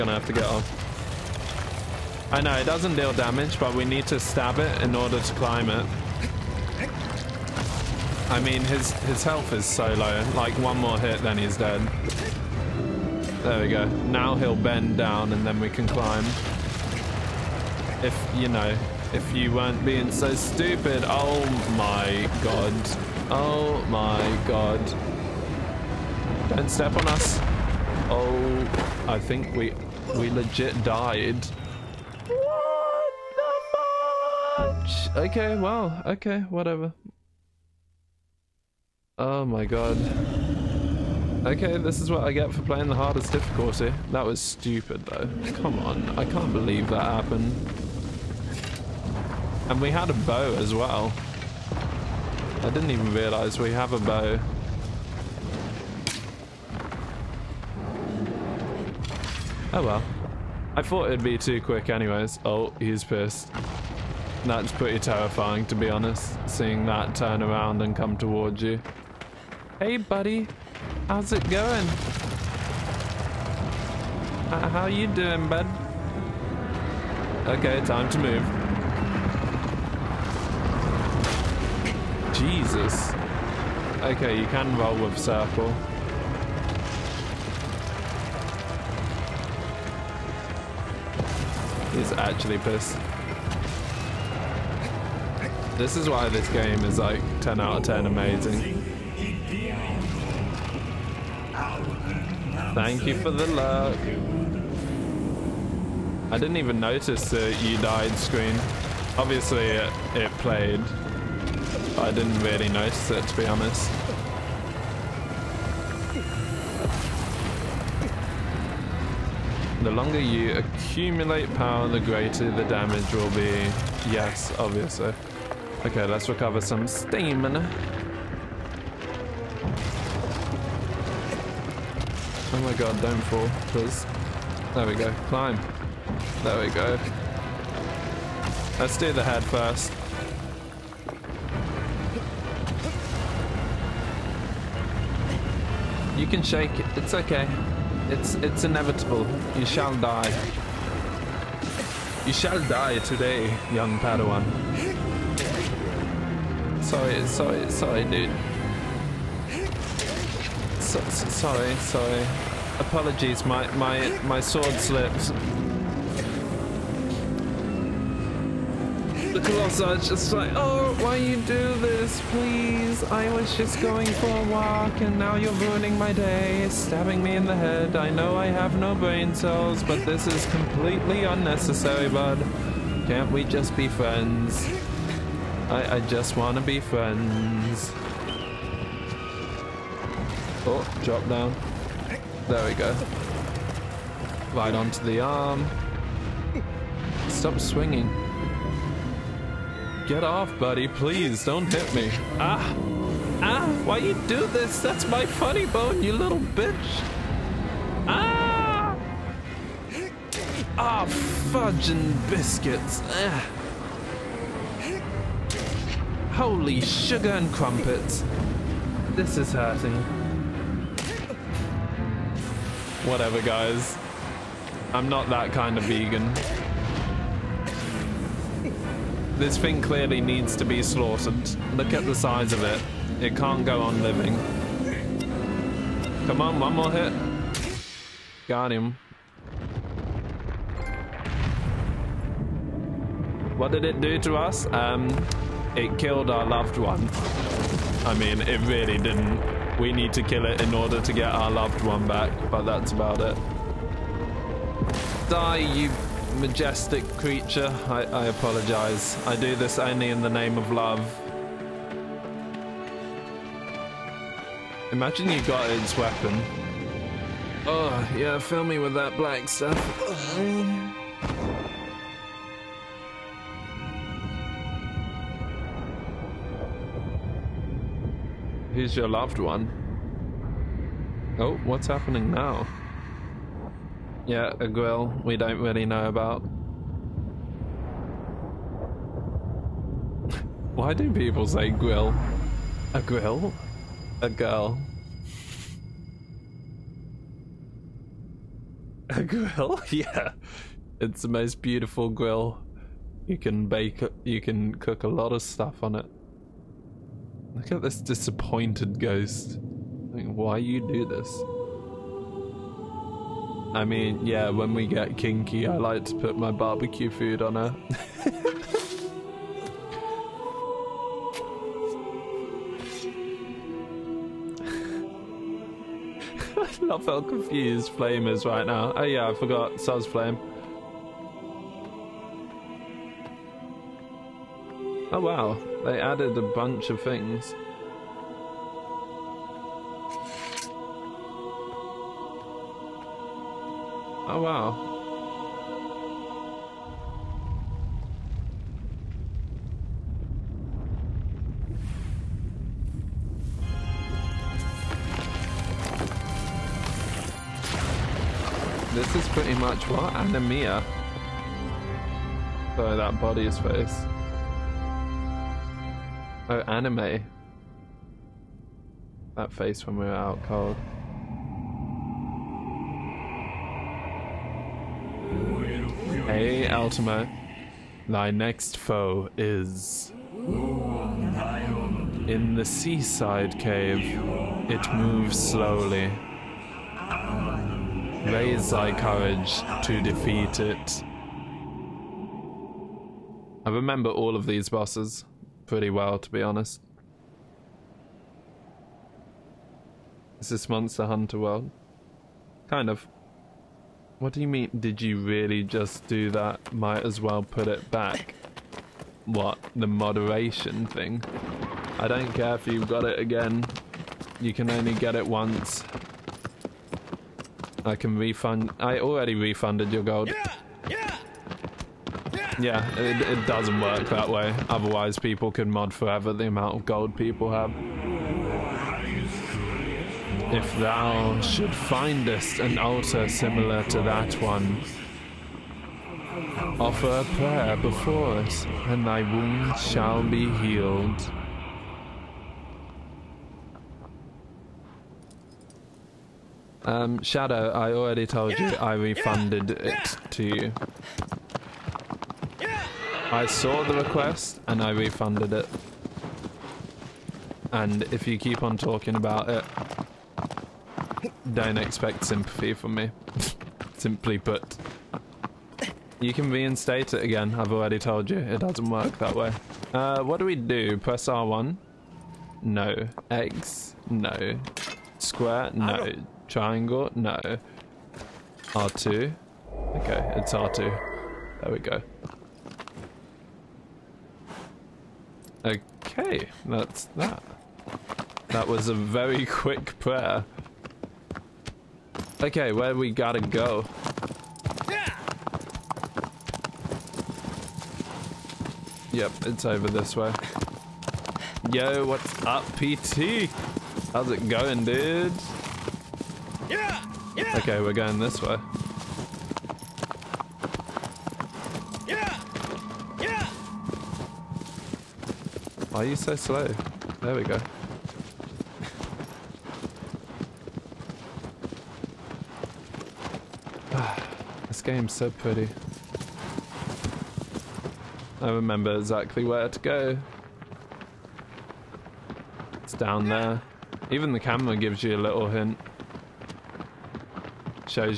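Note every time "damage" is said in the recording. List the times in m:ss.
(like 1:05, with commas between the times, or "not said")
0:03, 2:02.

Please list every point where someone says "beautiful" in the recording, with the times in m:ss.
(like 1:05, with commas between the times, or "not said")
5:01.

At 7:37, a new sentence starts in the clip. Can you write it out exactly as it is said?
And if you keep on talking about it, don't expect sympathy from me.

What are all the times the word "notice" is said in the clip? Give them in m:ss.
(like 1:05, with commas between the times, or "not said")
1:46, 1:52.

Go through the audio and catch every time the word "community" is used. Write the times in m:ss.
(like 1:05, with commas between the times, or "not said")
not said.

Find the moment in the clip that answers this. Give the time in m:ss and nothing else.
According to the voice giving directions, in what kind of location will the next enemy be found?
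6:22.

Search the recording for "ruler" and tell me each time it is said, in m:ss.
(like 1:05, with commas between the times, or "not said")
not said.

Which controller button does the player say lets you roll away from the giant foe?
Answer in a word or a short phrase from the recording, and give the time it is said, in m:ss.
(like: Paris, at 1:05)
Circle, at 1:25.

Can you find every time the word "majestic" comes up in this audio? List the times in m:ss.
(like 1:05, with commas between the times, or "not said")
4:16.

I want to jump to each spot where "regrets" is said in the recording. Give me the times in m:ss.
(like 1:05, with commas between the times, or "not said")
not said.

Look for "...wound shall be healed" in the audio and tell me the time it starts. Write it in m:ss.
7:19.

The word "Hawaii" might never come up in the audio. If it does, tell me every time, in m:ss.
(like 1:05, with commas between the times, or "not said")
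not said.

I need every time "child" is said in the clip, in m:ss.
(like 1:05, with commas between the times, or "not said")
not said.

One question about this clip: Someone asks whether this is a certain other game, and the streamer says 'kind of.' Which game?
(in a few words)
Monster Hunter World.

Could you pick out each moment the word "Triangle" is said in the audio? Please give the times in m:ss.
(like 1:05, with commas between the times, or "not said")
7:56.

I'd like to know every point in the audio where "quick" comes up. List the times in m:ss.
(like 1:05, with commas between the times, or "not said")
1:01, 8:09.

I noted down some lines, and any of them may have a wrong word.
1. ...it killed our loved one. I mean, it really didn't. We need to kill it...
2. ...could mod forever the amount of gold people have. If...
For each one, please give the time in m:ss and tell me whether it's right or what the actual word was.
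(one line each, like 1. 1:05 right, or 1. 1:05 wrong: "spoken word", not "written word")
1. 4:05 right
2. 7:05 right.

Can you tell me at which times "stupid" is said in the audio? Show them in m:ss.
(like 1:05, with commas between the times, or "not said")
0:20, 0:44.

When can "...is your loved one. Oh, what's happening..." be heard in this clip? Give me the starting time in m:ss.
4:38.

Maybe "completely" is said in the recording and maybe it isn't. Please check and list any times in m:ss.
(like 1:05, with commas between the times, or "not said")
3:00.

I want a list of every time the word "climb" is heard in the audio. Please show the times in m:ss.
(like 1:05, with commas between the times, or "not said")
0:05, 0:15, 2:15.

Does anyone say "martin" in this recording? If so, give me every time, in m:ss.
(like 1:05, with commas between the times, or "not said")
not said.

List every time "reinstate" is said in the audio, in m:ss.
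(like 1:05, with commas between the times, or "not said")
7:46.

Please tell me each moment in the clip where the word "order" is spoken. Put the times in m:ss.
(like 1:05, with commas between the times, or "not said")
0:04, 4:10.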